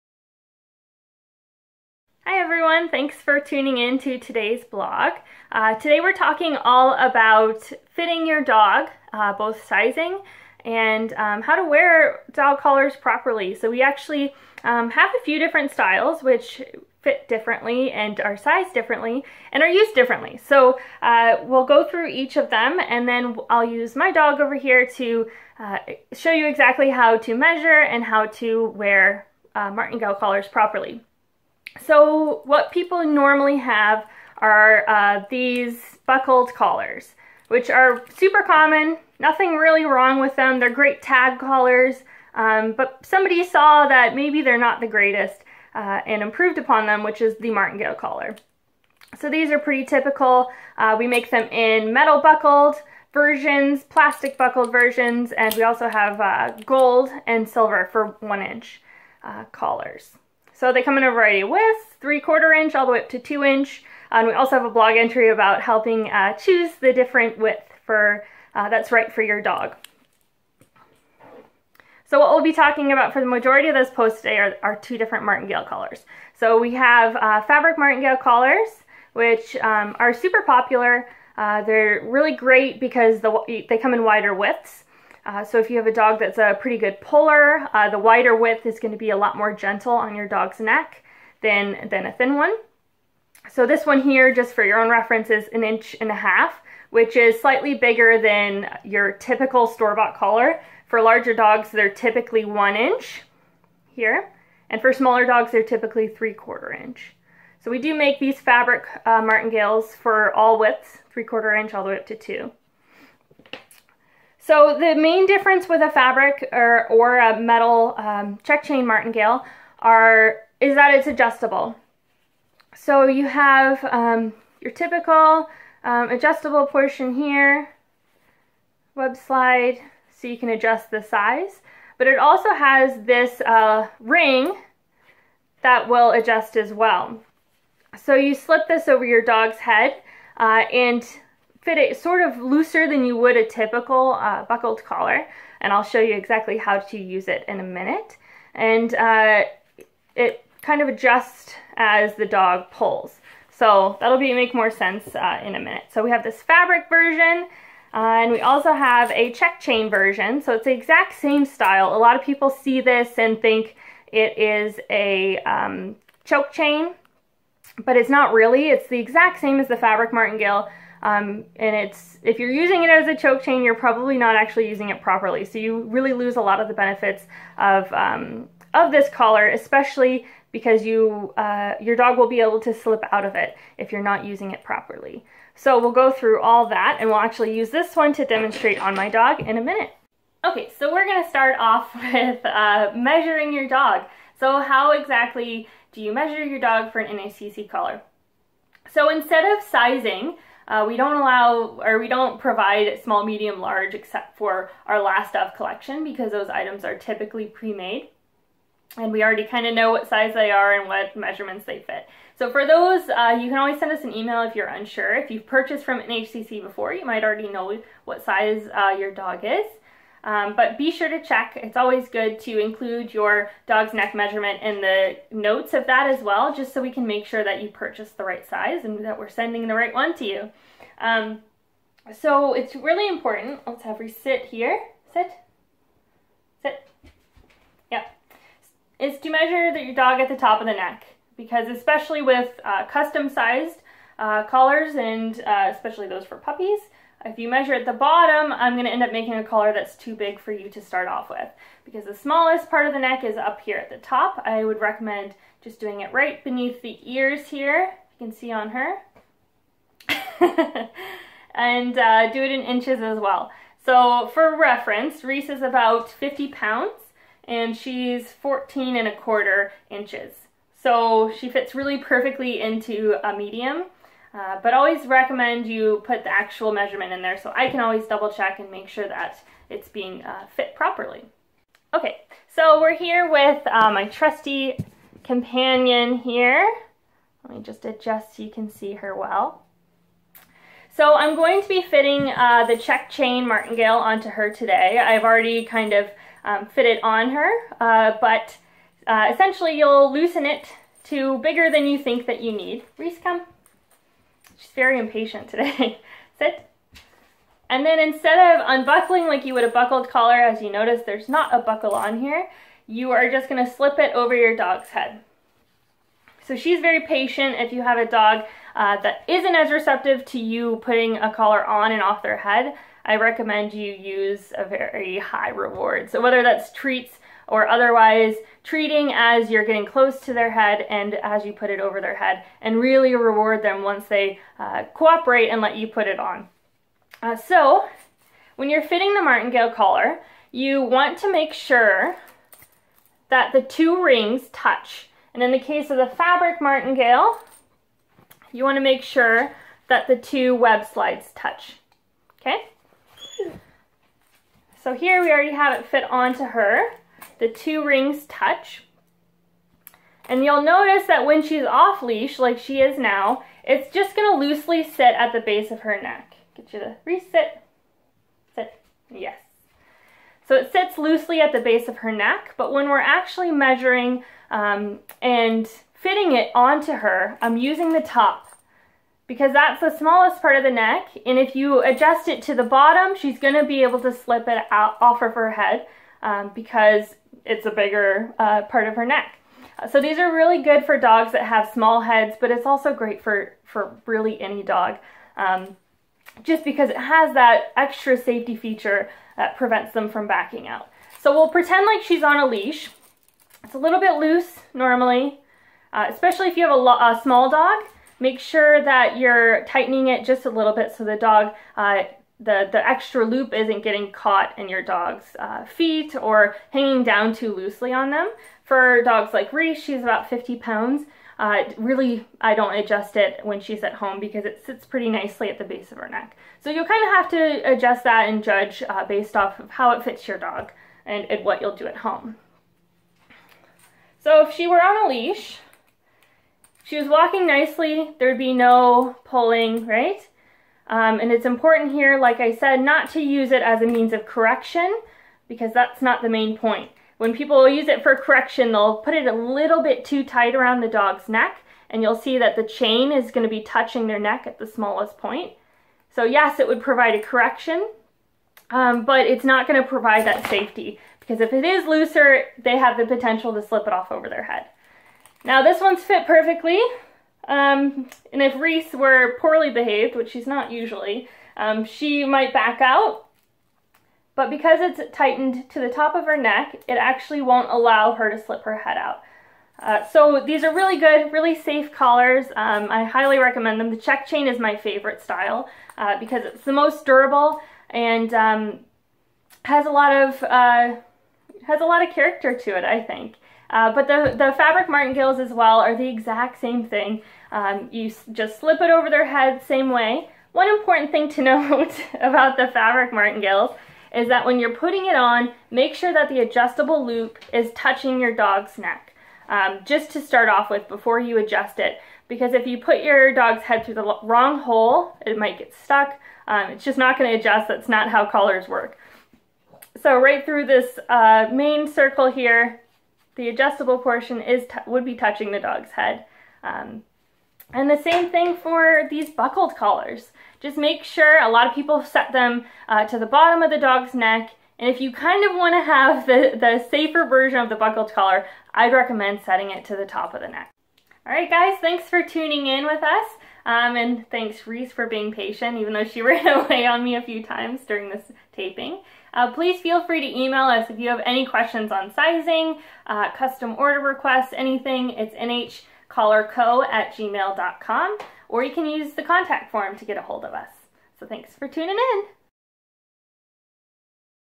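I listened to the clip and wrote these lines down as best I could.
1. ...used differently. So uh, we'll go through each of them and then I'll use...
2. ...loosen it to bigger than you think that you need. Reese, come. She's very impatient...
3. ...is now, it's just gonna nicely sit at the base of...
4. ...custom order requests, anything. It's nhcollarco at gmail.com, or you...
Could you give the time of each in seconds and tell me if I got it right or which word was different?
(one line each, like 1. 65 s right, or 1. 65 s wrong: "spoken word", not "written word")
1. 19 s right
2. 300 s right
3. 362 s wrong: "loosely", not "nicely"
4. 553 s right.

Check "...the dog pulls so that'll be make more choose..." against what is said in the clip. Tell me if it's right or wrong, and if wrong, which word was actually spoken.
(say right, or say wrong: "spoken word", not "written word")
wrong: "sense", not "choose".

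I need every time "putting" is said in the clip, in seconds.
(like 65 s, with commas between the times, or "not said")
320 s, 504 s.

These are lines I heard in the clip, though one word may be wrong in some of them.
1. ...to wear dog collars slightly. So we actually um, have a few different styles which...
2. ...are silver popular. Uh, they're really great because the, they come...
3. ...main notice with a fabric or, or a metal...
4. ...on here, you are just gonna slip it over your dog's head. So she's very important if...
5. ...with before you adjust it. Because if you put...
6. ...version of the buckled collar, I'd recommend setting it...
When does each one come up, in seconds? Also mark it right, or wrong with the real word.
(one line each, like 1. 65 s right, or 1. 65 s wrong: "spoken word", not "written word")
1. 11 s wrong: "properly", not "slightly"
2. 79 s wrong: "super", not "silver"
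3. 114 s wrong: "difference", not "notice"
4. 311 s wrong: "patient", not "important"
5. 510 s right
6. 537 s right.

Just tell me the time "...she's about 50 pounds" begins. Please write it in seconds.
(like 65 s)
419 s.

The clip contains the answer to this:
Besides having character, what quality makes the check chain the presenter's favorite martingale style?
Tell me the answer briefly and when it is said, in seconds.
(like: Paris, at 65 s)
most durable, at 486 s.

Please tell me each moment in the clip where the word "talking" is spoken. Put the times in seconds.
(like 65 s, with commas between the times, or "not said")
6 s, 72 s.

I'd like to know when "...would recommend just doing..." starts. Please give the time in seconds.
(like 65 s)
254 s.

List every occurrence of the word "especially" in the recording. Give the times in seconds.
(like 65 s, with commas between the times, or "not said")
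179 s, 241 s, 245 s, 406 s.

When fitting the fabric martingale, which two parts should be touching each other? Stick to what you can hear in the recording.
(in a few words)
the two web slides.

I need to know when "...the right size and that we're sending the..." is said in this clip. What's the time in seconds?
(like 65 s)
228 s.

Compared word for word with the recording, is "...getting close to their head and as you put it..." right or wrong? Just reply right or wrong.
right.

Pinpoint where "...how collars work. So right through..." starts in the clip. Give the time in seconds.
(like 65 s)
518 s.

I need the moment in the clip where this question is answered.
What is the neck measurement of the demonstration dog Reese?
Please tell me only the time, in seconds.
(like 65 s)
268 s.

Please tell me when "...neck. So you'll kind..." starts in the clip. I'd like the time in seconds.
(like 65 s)
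426 s.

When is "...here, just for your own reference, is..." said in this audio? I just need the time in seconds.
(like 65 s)
94 s.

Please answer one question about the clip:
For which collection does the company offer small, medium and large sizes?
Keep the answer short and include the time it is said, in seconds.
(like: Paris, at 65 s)
last of collection, at 205 s.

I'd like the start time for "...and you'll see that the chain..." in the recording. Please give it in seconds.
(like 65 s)
451 s.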